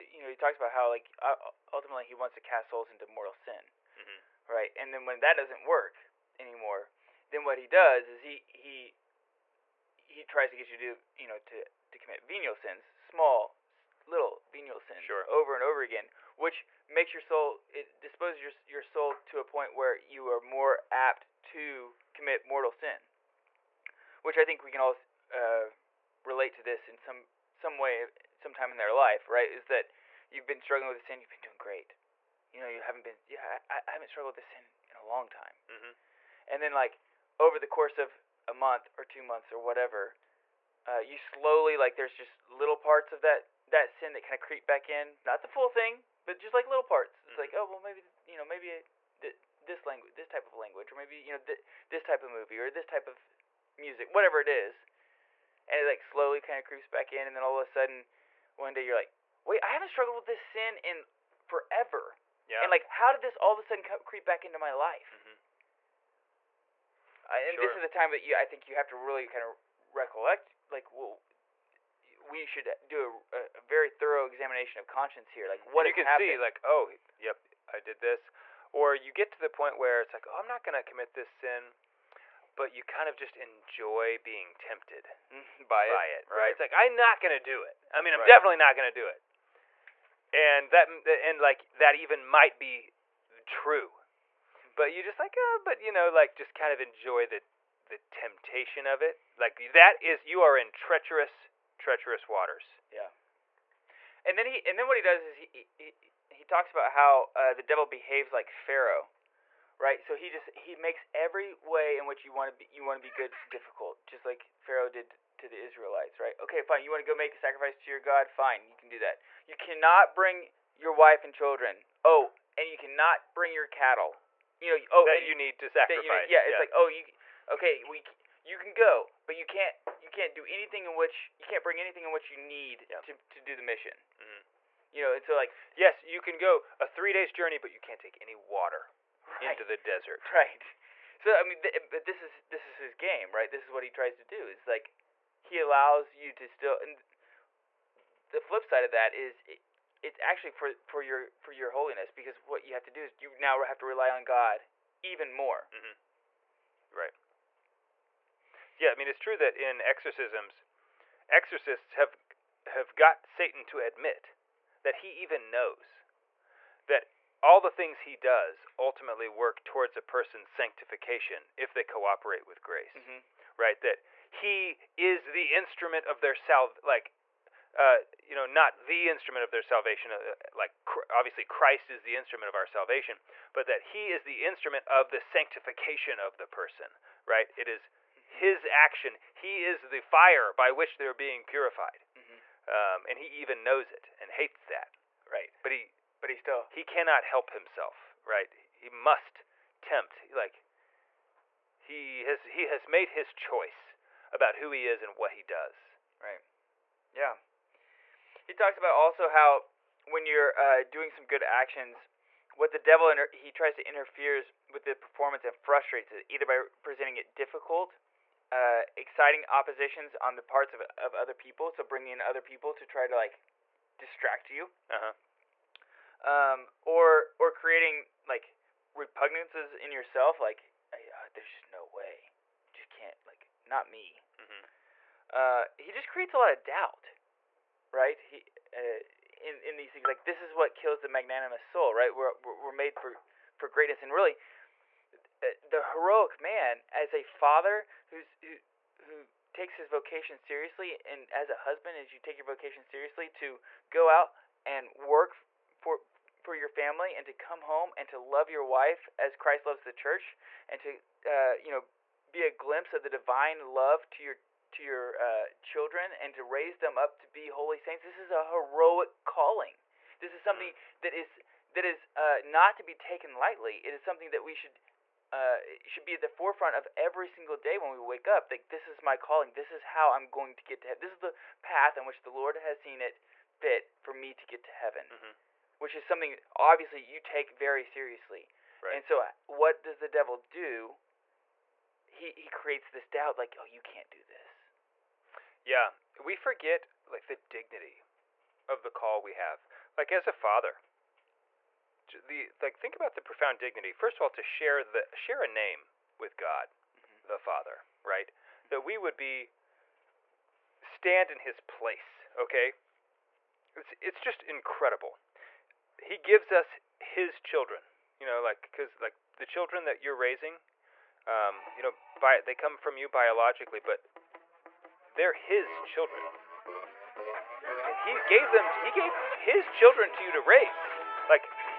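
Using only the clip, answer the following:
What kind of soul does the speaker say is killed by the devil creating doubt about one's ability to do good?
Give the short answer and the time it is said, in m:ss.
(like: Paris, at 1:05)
Magnanimous, at 4:01.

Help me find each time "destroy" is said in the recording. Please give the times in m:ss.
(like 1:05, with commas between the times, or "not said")
not said.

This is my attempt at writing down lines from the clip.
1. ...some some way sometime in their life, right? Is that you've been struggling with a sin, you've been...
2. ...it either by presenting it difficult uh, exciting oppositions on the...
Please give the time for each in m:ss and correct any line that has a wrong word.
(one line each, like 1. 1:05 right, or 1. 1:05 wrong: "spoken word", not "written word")
1. 0:26 right
2. 3:36 right.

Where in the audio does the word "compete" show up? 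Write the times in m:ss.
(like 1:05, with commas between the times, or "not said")
not said.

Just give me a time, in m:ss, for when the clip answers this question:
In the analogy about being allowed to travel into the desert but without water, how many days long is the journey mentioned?
2:16.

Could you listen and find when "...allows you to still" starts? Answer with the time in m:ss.
2:25.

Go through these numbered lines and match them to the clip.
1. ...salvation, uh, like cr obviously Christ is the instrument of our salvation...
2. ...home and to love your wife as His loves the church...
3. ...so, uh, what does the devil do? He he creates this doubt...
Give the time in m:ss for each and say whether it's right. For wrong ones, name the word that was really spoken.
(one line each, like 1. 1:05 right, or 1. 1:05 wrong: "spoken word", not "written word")
1. 2:59 right
2. 4:17 wrong: "Christ", not "His"
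3. 4:49 right.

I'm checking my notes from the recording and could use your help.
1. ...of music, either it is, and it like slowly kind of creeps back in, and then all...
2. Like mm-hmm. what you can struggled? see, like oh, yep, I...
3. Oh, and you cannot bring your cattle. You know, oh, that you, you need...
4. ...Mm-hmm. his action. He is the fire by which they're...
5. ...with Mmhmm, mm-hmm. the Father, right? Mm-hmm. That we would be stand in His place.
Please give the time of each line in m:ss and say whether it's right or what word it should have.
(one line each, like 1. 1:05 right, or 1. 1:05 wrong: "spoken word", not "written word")
1. 0:53 wrong: "whatever", not "either"
2. 1:15 wrong: "happened", not "struggled"
3. 2:02 right
4. 3:08 right
5. 5:06 wrong: "God", not "Mmhmm".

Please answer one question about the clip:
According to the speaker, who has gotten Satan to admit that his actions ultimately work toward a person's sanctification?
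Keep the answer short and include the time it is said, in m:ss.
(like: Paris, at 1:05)
Exorcists, at 2:41.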